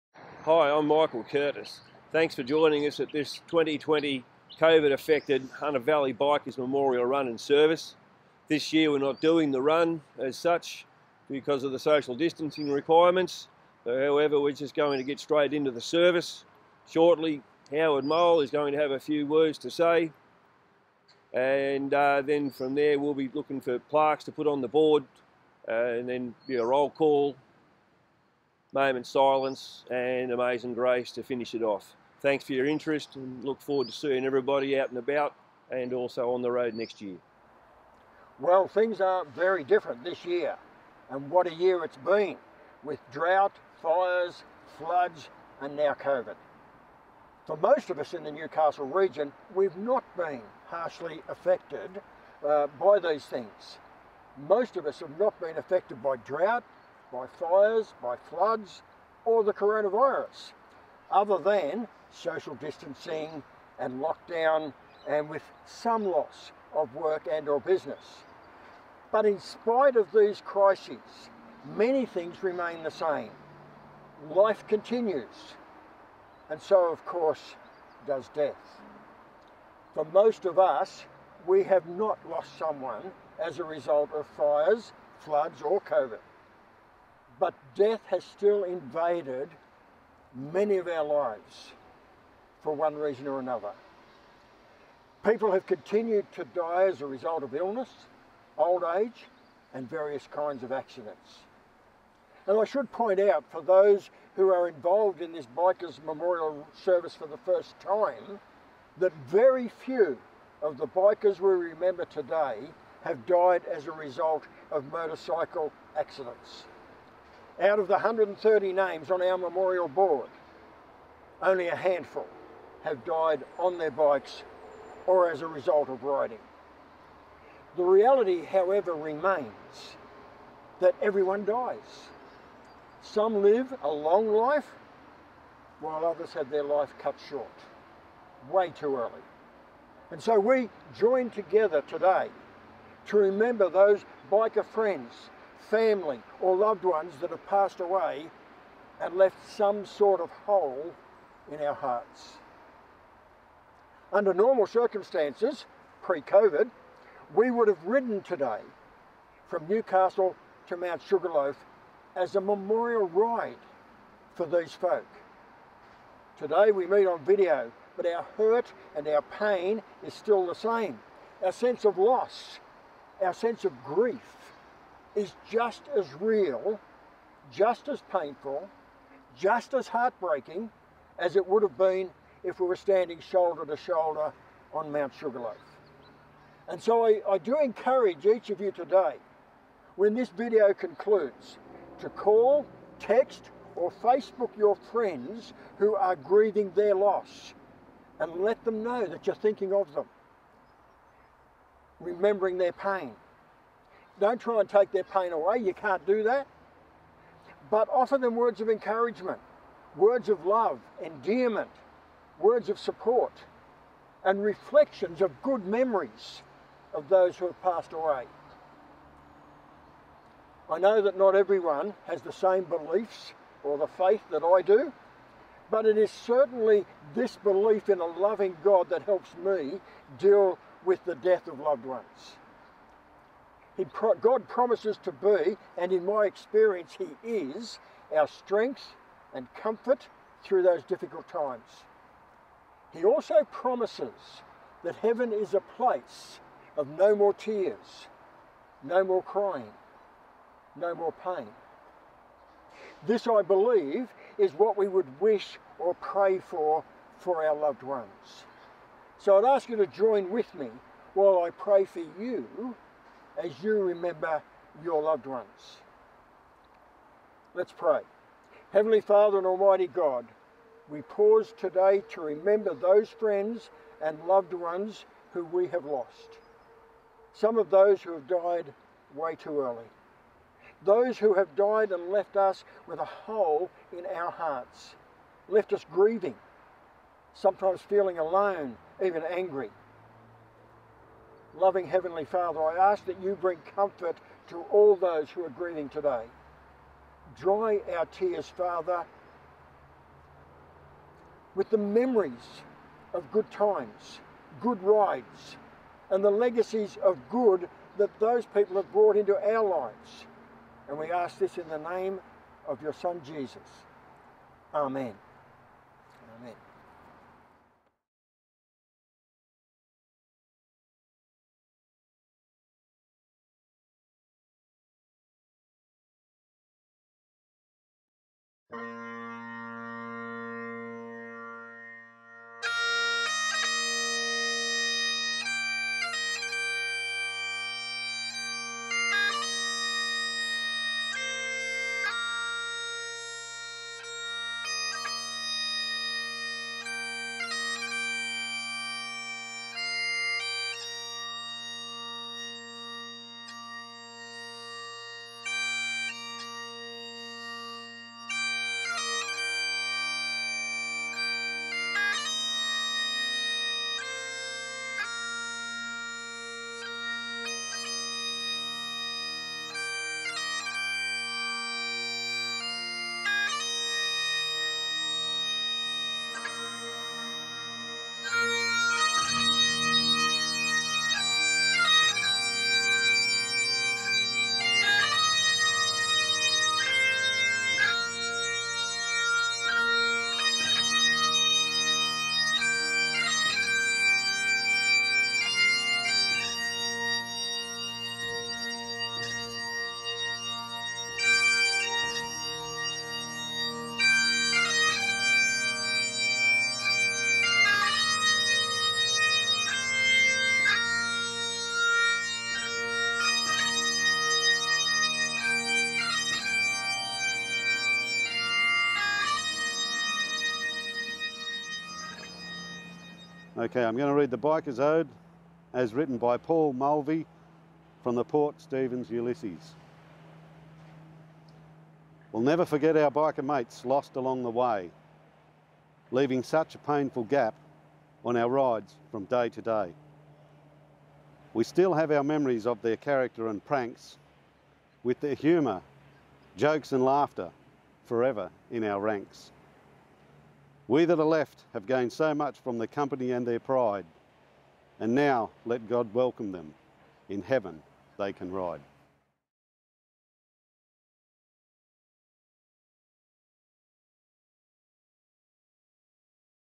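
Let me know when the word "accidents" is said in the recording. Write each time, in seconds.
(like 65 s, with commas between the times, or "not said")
100 s, 115 s.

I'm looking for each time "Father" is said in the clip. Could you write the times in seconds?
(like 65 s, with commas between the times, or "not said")
269 s, 292 s, 298 s.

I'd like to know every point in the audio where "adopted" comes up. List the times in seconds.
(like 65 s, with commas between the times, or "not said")
not said.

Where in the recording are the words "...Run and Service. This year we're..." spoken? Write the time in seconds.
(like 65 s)
7 s.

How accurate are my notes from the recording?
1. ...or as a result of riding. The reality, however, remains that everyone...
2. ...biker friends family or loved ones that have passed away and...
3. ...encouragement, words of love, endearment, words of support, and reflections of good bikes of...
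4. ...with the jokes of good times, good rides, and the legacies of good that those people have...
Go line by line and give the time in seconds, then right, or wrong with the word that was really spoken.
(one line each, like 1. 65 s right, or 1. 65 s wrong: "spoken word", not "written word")
1. 125 s right
2. 144 s right
3. 208 s wrong: "memories", not "bikes"
4. 301 s wrong: "memories", not "jokes".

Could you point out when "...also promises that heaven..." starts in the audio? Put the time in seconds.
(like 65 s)
243 s.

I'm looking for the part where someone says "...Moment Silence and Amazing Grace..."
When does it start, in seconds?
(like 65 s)
28 s.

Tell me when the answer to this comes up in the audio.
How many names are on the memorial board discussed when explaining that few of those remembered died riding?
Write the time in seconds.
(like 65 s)
117 s.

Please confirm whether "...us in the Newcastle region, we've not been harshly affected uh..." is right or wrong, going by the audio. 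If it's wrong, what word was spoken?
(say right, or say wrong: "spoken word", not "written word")
right.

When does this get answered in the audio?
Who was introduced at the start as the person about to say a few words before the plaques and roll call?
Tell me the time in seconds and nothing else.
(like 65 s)
17 s.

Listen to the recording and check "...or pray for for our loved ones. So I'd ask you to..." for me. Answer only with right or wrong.
right.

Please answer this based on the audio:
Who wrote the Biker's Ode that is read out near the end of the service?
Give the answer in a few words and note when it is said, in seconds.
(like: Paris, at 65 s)
Paul Mulvey, at 426 s.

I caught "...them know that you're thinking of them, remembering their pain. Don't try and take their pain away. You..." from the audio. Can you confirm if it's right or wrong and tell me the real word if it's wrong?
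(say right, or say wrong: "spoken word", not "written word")
right.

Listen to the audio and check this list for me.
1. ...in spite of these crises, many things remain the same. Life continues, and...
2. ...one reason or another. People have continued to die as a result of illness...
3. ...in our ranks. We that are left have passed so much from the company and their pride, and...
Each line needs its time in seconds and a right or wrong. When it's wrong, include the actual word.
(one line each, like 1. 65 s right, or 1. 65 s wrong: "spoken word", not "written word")
1. 69 s right
2. 92 s right
3. 448 s wrong: "gained", not "passed".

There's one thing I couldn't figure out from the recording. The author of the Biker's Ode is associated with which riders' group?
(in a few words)
Port Stephens Ulysses.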